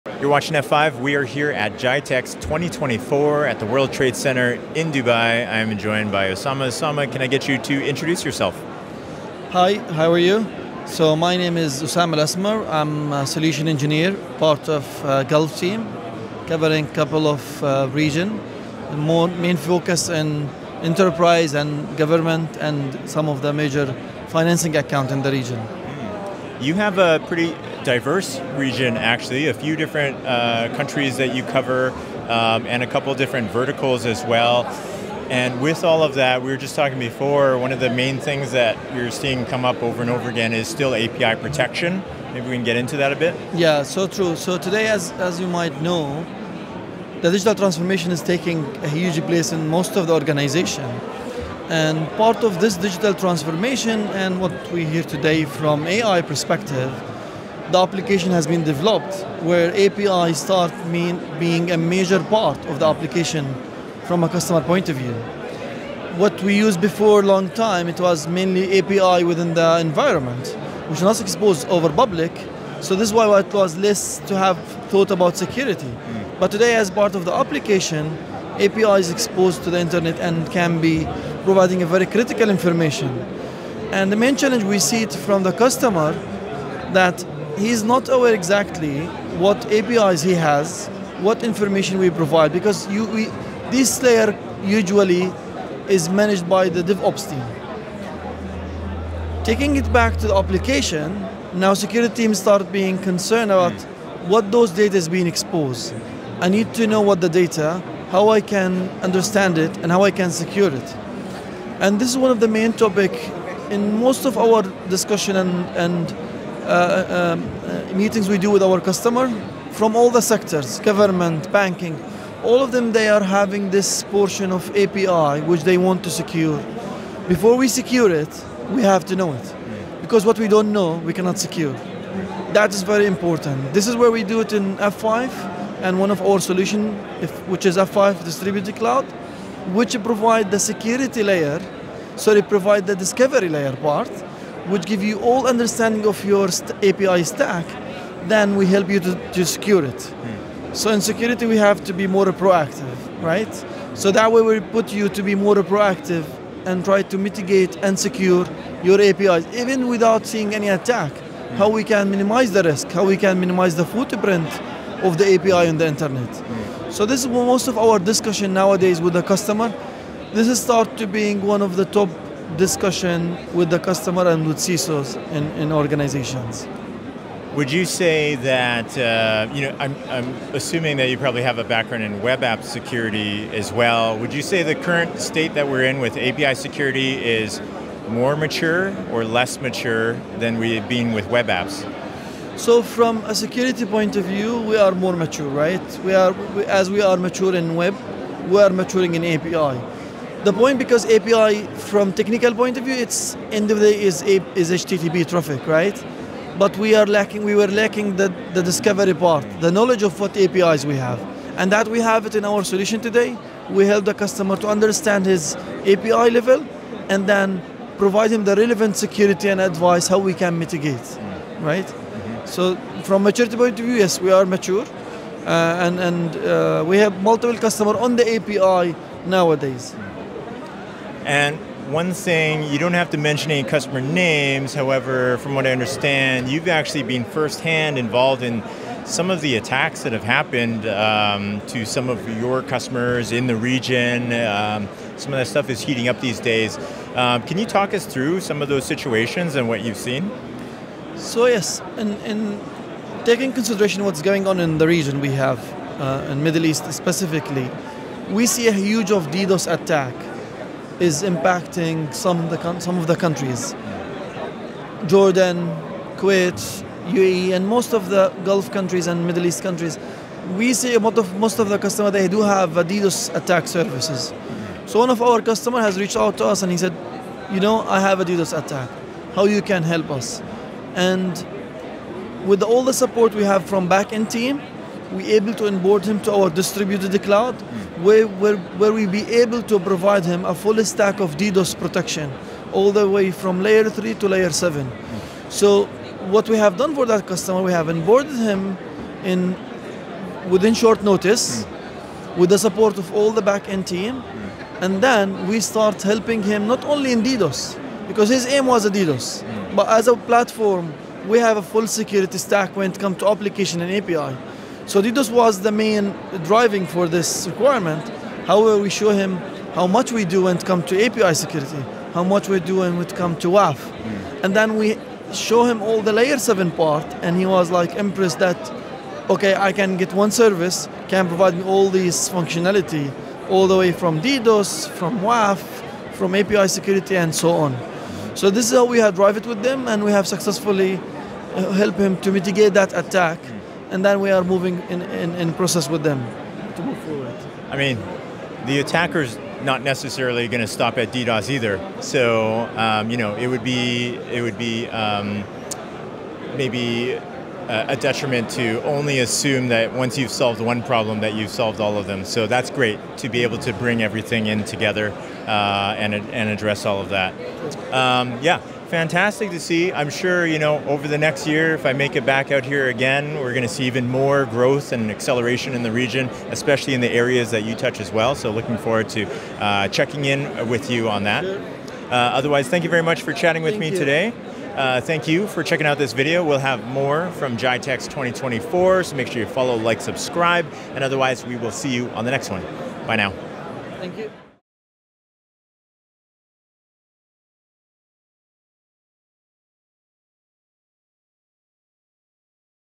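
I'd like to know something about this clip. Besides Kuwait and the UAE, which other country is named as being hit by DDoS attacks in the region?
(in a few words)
Jordan.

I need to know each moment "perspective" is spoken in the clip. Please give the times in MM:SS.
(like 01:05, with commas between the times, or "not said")
00:56.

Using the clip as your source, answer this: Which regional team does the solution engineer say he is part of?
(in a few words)
Gulf team.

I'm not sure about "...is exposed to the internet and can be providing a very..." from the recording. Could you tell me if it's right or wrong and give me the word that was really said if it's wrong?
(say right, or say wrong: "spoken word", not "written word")
right.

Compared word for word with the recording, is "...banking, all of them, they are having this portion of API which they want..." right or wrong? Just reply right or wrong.
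right.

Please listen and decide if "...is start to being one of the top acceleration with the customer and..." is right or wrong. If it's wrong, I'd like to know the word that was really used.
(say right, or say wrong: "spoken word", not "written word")
wrong: "discussion", not "acceleration".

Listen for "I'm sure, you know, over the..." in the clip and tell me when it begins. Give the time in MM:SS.
06:09.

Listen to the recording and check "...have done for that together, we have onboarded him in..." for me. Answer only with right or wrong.
wrong.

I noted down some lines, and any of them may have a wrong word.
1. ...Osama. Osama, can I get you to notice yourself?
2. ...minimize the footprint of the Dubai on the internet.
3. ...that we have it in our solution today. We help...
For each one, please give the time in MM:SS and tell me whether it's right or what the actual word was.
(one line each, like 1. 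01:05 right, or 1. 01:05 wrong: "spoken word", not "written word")
1. 00:06 wrong: "introduce", not "notice"
2. 02:43 wrong: "API", not "Dubai"
3. 03:31 right.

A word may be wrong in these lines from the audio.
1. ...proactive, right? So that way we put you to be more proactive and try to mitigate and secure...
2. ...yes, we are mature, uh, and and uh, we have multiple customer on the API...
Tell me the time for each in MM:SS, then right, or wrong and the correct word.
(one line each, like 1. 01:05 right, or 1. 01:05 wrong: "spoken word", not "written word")
1. 02:32 right
2. 03:43 right.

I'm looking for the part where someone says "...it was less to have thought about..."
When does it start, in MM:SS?
01:13.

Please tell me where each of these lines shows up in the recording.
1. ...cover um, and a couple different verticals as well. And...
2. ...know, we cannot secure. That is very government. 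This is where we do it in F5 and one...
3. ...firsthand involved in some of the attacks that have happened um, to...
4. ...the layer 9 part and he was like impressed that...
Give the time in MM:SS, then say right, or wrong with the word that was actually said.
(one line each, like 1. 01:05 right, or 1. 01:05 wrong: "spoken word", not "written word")
1. 00:31 right
2. 02:10 wrong: "important", not "government"
3. 03:57 right
4. 05:26 wrong: "7", not "9".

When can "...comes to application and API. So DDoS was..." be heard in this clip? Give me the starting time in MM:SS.
05:12.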